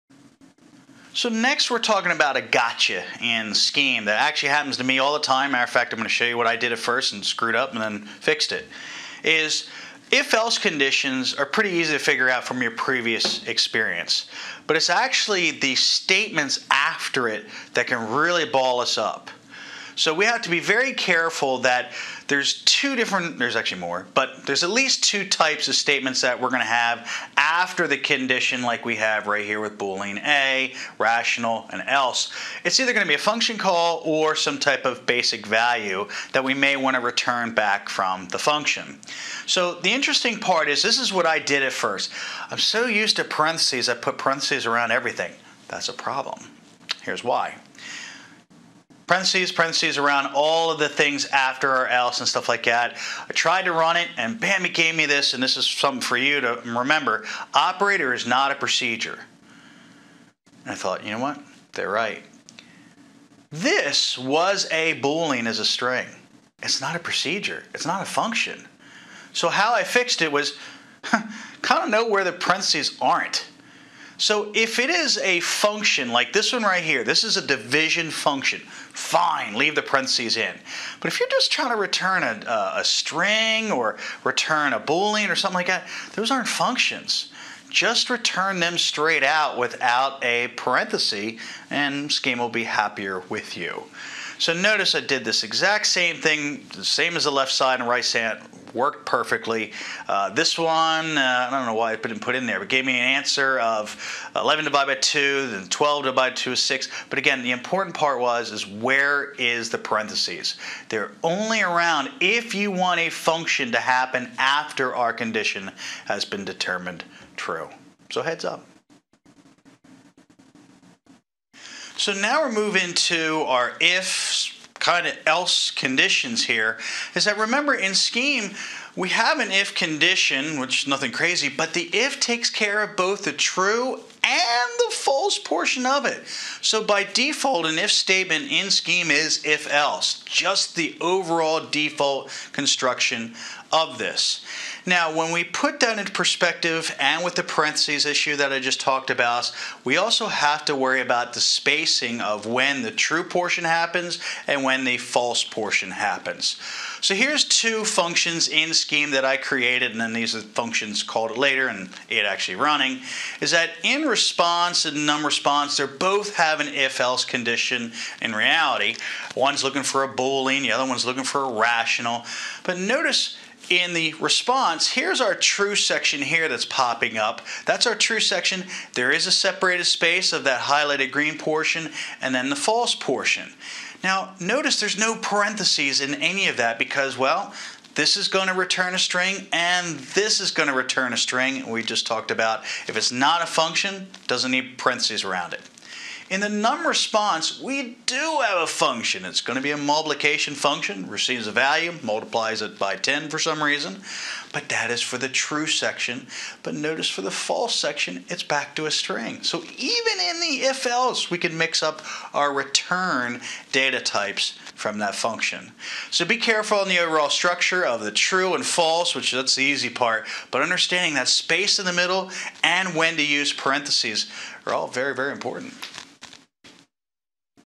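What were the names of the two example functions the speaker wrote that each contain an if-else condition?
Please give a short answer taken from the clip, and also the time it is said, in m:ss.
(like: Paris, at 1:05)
response and num response, at 2:44.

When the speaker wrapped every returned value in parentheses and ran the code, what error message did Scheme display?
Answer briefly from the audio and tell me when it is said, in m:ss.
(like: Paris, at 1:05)
Operator is not a procedure, at 0:57.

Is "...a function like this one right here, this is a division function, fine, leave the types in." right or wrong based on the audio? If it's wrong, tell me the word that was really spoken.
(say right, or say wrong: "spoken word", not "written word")
wrong: "parentheses", not "types".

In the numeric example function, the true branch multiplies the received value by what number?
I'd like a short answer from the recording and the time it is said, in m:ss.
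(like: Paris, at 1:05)
10, at 3:22.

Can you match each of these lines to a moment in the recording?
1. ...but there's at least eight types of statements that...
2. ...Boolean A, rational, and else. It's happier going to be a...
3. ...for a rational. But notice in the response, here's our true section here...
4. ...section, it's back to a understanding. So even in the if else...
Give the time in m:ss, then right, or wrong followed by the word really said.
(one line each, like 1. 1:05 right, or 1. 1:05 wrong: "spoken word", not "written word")
1. 0:24 wrong: "two", not "eight"
2. 0:29 wrong: "either", not "happier"
3. 2:51 right
4. 3:27 wrong: "string", not "understanding".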